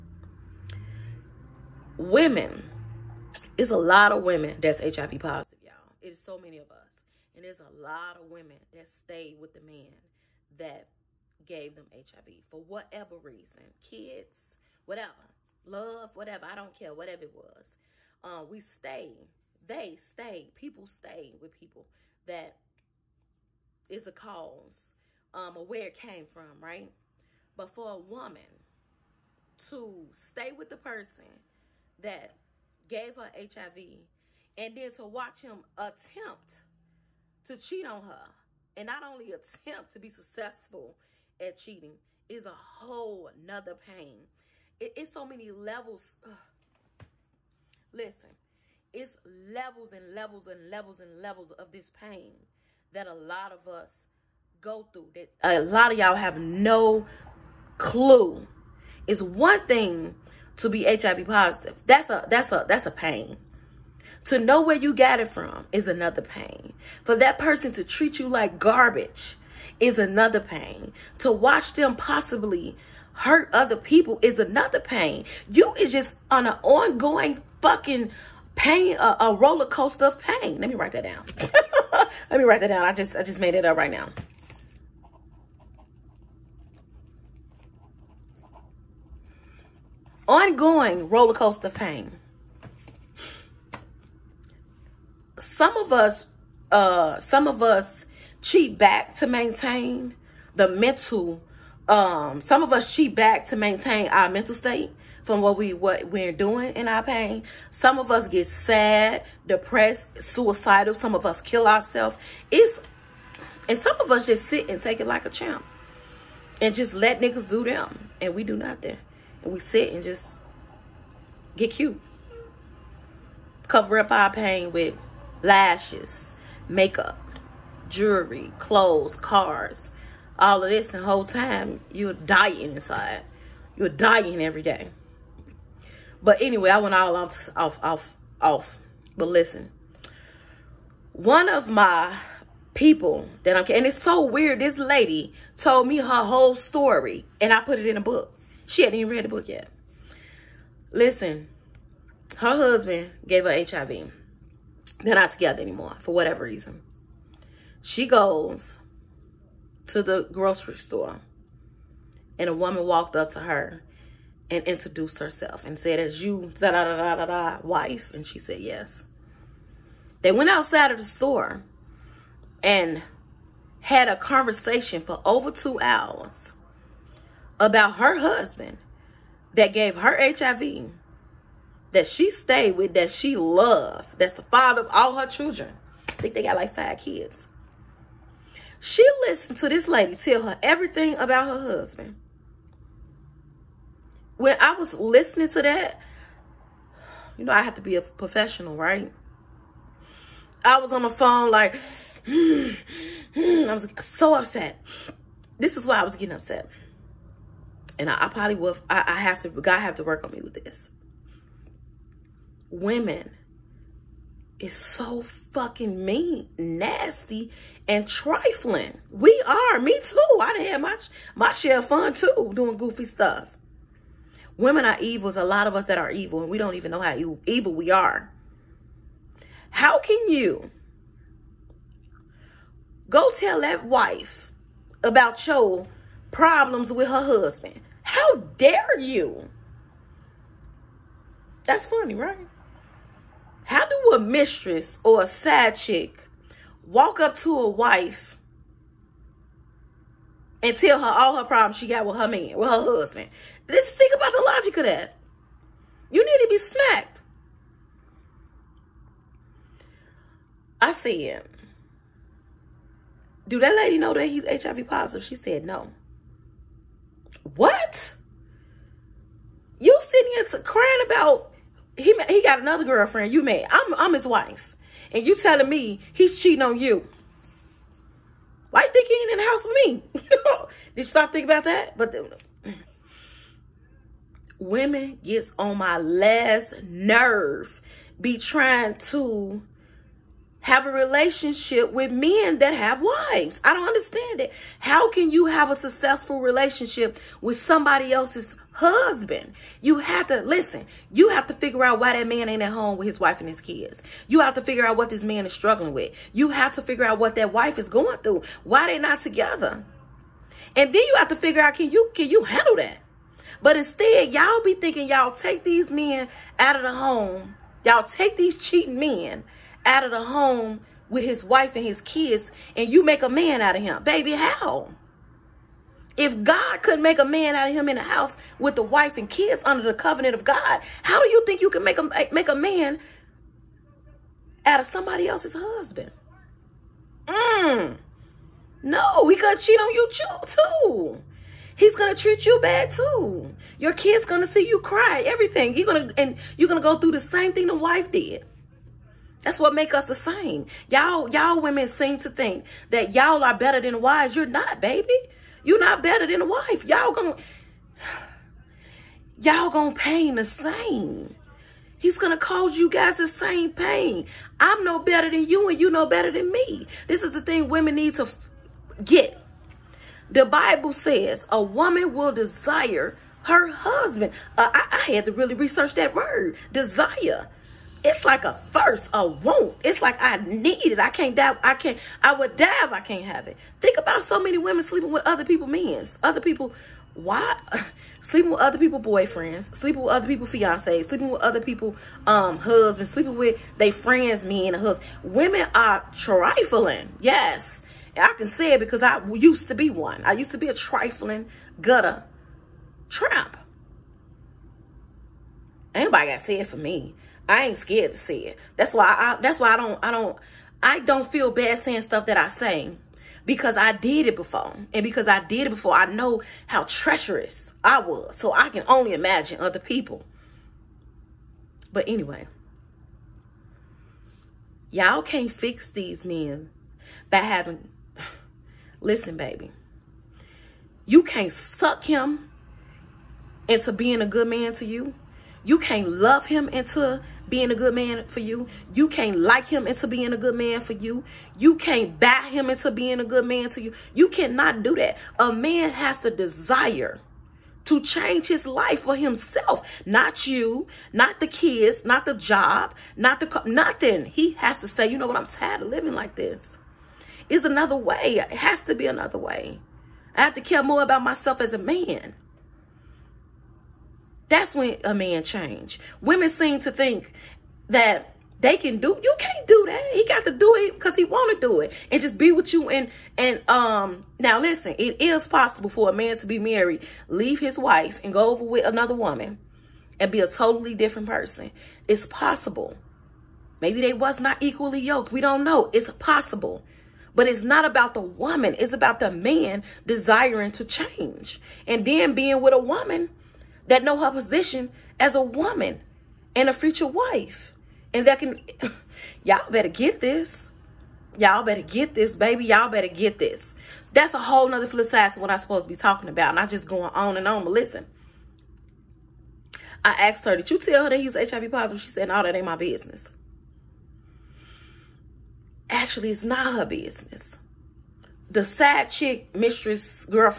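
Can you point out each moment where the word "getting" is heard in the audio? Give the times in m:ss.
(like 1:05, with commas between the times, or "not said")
3:26.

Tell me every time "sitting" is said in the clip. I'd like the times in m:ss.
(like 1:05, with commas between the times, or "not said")
4:30.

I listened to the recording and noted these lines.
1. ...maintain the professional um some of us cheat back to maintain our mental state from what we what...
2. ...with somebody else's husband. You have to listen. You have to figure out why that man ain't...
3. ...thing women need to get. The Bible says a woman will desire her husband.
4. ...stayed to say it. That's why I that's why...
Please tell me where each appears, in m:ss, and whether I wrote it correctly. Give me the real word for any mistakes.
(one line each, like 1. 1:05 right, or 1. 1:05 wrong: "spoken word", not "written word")
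1. 1:39 wrong: "mental", not "professional"
2. 4:57 right
3. 6:07 right
4. 6:47 wrong: "scared", not "stayed".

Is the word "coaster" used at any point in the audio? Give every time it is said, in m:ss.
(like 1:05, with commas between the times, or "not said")
1:19, 1:31.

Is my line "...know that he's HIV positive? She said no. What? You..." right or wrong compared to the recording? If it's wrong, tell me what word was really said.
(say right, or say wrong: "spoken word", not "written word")
right.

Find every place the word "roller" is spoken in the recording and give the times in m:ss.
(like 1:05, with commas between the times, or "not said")
1:19, 1:31.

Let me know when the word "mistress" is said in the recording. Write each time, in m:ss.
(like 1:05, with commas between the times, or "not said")
4:04, 8:39.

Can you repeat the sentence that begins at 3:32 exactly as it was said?
Women is so fucking mean, nasty, and trifling.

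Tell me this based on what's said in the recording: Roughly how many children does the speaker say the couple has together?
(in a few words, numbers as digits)
5.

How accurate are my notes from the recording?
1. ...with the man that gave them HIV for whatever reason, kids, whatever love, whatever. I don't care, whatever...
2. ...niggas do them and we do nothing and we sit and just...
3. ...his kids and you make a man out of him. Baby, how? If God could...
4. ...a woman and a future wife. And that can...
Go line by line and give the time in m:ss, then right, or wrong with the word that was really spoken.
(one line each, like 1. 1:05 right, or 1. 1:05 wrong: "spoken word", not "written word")
1. 0:09 right
2. 1:57 right
3. 5:21 right
4. 8:15 right.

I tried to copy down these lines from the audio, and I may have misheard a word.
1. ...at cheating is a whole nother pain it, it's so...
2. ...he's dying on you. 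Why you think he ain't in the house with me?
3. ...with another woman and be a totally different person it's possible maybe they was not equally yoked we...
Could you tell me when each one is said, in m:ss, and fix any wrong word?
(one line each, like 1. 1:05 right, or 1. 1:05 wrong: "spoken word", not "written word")
1. 0:41 right
2. 4:36 wrong: "cheating", not "dying"
3. 7:58 right.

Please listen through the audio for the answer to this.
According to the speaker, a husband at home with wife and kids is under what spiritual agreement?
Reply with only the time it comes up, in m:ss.
5:29.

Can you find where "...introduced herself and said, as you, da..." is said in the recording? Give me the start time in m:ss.
2:44.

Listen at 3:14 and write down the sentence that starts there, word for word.
When I was listening to that, you know, I have to be a professional, right?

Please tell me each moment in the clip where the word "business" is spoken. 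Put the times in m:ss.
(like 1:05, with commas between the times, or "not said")
8:32, 8:36.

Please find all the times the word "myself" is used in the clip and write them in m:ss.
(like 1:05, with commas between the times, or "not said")
7:41.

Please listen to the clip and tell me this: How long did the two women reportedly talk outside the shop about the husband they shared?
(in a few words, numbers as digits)
over two hours.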